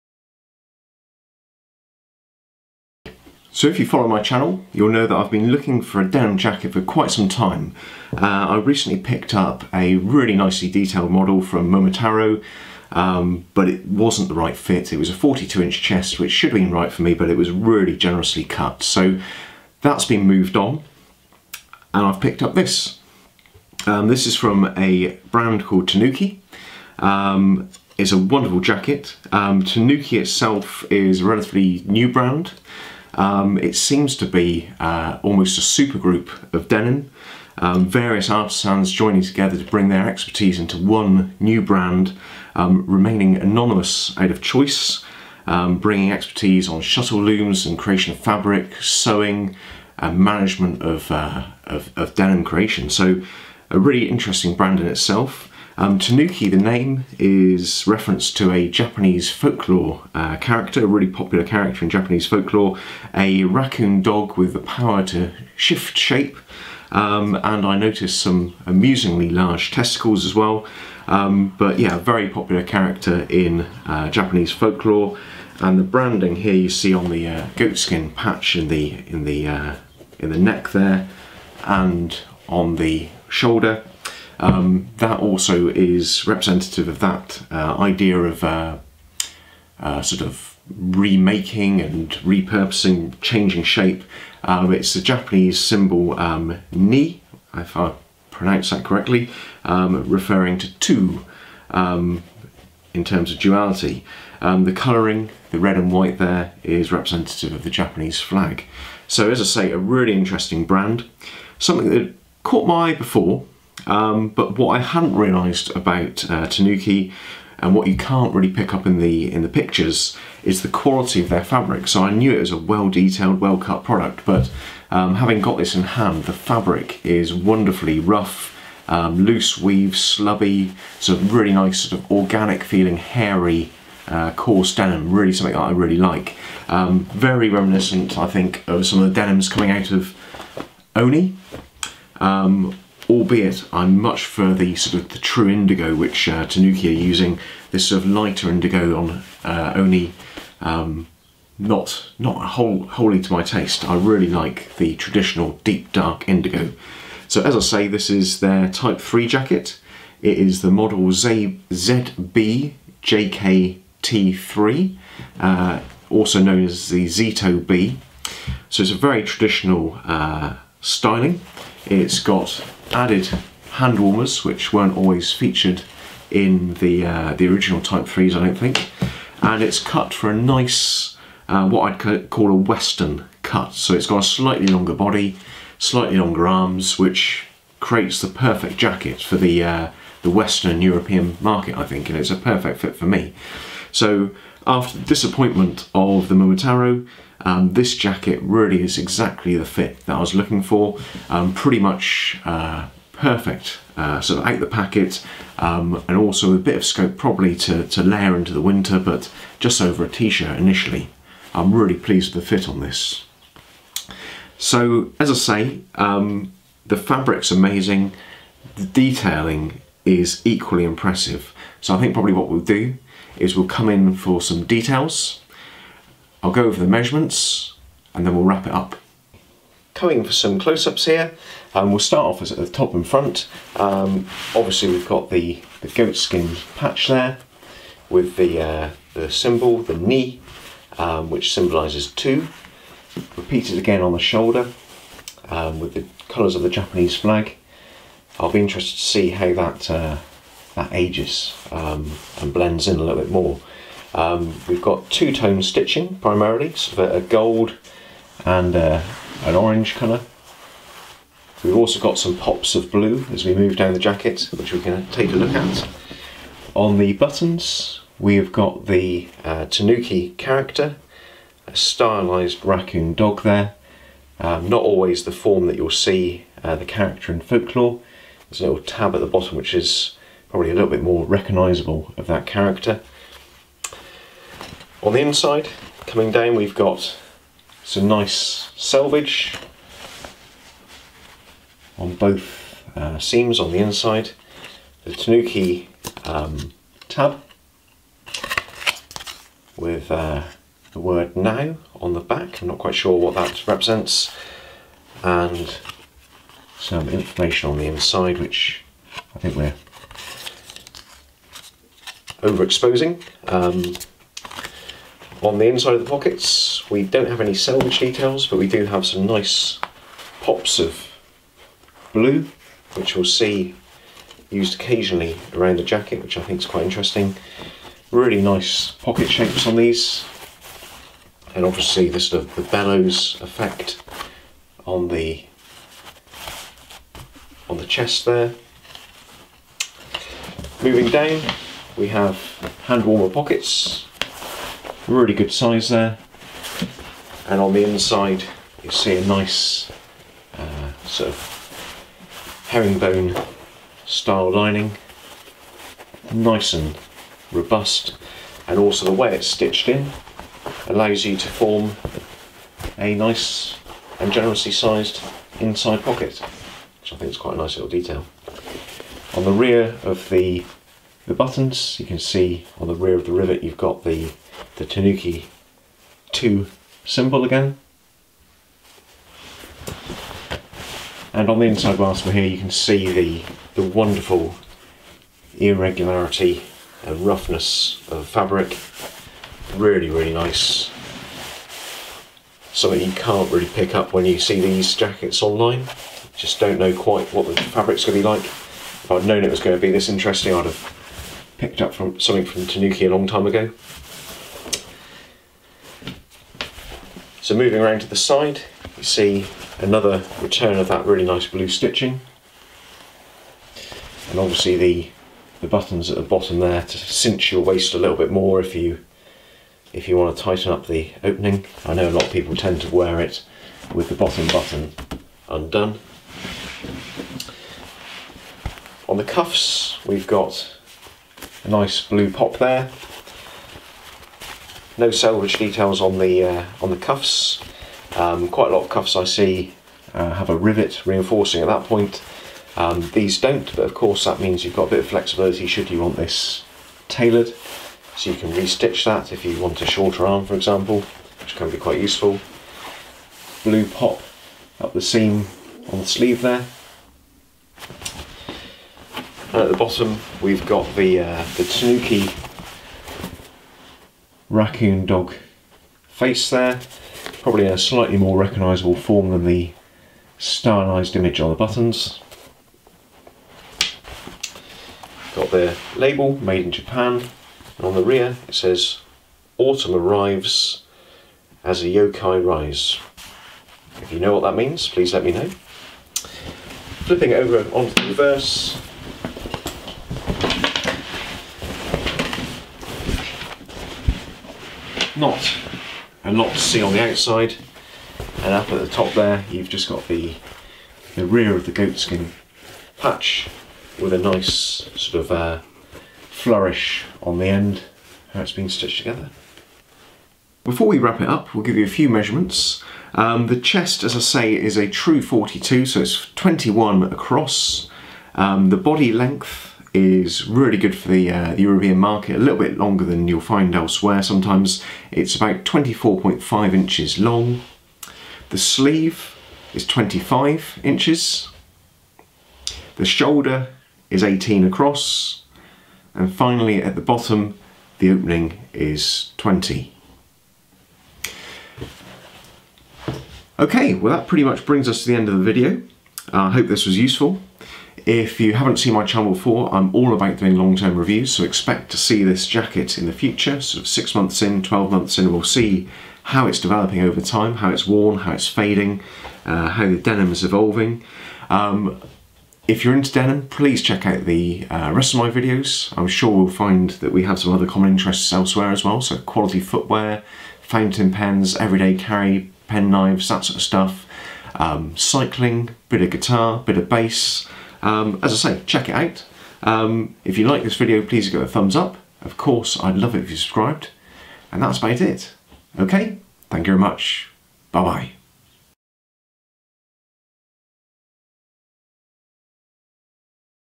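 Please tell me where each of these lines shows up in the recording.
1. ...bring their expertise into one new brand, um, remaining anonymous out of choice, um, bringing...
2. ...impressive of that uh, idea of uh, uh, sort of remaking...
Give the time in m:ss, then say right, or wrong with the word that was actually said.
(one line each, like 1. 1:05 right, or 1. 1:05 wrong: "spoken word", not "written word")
1. 0:39 right
2. 1:26 wrong: "representative", not "impressive".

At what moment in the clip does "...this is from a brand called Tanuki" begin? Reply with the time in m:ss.
0:24.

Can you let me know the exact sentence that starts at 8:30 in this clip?
Before we wrap it up, we'll give you a few measurements.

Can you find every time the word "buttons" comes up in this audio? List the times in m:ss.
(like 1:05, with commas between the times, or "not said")
4:27, 6:11, 6:55, 7:04, 7:51.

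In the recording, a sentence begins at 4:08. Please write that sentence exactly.
I'll be interested to see how that uh, that ages um, and blends in a little bit more.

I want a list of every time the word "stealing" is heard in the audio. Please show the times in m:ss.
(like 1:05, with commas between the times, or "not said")
not said.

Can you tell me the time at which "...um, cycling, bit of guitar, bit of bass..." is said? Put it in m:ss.
9:34.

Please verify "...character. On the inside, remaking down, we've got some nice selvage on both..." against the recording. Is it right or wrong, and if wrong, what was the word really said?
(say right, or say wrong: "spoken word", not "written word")
wrong: "coming", not "remaking".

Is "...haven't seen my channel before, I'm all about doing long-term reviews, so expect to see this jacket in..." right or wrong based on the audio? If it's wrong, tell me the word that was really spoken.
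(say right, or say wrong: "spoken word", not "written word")
right.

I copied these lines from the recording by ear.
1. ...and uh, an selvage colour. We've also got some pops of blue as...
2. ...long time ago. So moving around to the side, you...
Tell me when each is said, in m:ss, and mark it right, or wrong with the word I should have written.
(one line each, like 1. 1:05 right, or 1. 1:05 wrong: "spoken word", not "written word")
1. 4:18 wrong: "orange", not "selvage"
2. 6:43 right.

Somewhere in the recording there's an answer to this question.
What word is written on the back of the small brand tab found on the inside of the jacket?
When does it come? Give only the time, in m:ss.
5:01.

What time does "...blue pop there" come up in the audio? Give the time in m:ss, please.
7:12.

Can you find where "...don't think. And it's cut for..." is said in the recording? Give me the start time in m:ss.
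2:58.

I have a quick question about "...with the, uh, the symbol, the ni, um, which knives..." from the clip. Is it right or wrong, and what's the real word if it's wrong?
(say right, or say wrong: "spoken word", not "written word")
wrong: "symbolises", not "knives".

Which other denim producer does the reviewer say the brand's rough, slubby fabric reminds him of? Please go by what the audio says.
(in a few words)
Oni.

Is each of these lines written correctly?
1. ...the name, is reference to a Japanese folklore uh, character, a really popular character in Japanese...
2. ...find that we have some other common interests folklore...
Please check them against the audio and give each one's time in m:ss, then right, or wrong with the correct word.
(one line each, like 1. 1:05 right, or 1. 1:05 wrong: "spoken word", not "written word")
1. 0:56 right
2. 9:26 wrong: "elsewhere", not "folklore".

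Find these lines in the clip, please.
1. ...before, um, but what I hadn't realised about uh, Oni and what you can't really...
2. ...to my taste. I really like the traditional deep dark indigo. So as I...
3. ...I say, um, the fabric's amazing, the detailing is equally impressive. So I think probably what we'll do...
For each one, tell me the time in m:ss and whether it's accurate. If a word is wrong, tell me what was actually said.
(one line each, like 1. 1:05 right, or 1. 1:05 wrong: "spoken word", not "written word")
1. 1:52 wrong: "Tanuki", not "Oni"
2. 2:33 right
3. 3:35 right.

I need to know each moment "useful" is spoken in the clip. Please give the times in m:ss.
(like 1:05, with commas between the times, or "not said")
7:31, 9:06.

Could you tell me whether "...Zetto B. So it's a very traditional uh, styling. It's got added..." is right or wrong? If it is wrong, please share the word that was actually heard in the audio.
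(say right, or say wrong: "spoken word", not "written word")
right.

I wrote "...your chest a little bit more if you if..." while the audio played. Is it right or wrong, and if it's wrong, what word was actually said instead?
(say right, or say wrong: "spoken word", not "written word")
wrong: "waist", not "chest".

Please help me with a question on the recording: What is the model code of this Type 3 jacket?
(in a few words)
ZBJKT3.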